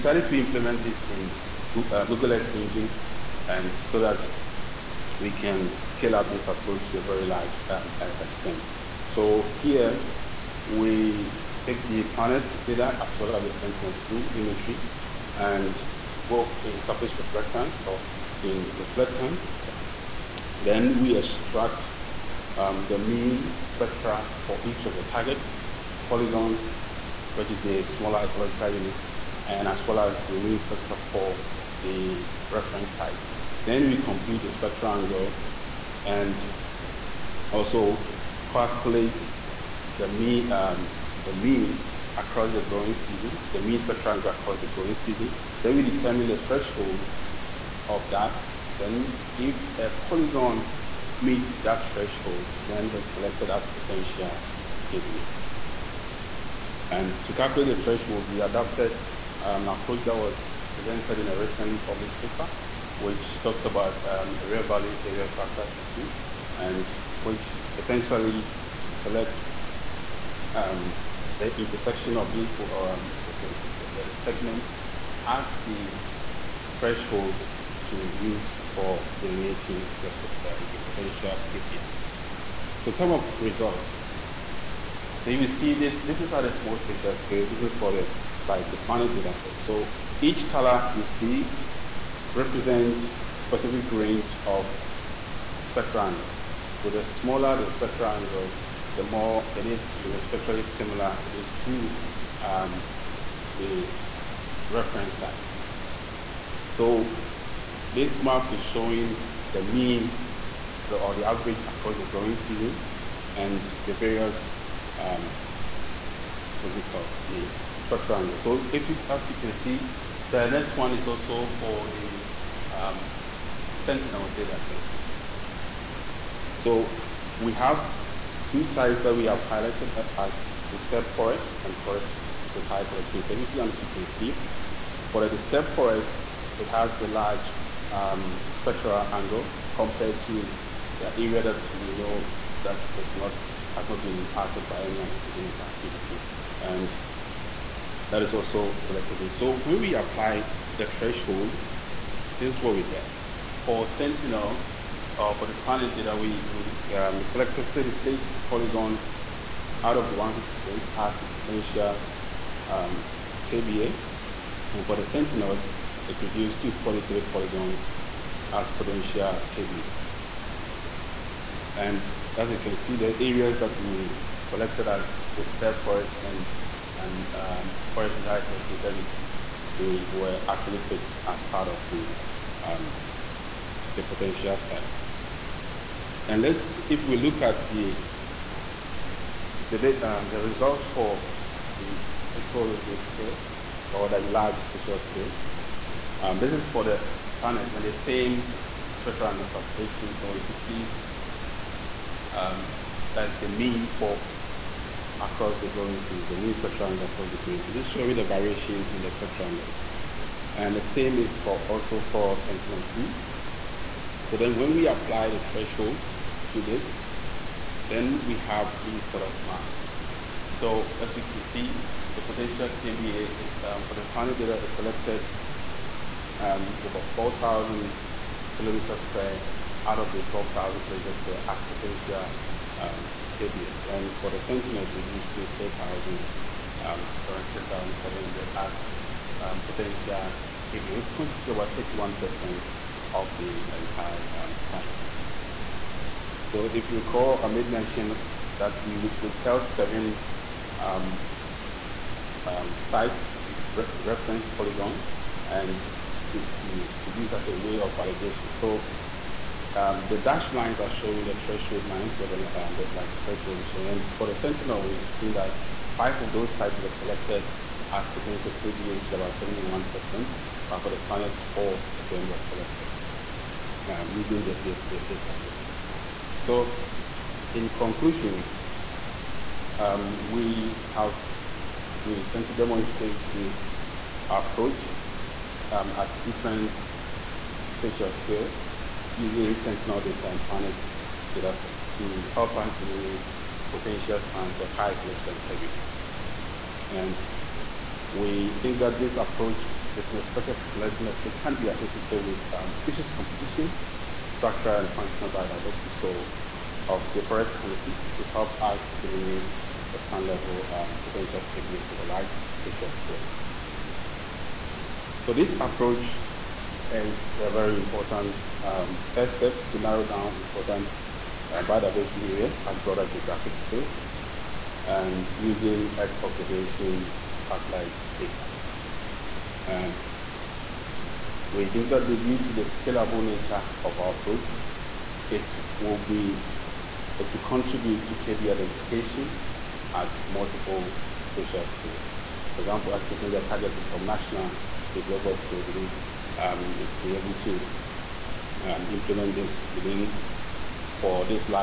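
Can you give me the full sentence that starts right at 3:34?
So then when we apply the threshold to this, then we have these sort of maps.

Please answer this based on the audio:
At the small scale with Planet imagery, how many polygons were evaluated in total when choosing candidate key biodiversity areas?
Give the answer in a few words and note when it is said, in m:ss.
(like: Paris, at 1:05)
158, at 2:40.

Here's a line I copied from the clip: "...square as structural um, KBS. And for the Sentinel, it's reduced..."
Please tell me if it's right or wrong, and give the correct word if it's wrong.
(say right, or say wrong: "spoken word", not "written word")
wrong: "potential", not "structural".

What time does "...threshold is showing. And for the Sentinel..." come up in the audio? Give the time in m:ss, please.
4:23.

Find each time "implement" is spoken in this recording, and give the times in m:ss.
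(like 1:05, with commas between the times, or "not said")
0:00, 5:48.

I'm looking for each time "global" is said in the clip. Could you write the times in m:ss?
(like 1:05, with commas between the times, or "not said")
5:45.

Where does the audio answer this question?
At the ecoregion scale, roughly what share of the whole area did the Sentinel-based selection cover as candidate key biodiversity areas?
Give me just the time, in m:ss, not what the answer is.
4:01.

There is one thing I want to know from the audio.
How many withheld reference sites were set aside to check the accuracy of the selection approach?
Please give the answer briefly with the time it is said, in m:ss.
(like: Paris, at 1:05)
7, at 4:09.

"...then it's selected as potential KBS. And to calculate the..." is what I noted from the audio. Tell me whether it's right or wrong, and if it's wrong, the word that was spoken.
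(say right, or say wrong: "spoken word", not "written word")
wrong: "KBA", not "KBS".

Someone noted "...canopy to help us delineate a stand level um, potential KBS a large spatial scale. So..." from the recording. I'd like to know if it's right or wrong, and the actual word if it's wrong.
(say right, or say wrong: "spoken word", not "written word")
right.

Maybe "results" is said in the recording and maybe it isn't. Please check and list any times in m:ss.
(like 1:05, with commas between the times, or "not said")
1:23, 3:10.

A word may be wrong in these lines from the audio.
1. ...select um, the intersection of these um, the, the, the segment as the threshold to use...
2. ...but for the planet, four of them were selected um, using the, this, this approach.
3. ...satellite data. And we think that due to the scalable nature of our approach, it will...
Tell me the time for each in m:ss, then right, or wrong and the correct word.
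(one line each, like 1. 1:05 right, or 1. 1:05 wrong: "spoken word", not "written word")
1. 1:08 right
2. 4:30 right
3. 5:27 right.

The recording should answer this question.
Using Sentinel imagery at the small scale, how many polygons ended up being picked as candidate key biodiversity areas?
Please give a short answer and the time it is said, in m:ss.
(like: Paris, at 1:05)
43, at 2:46.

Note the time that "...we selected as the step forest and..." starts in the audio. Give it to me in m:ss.
2:53.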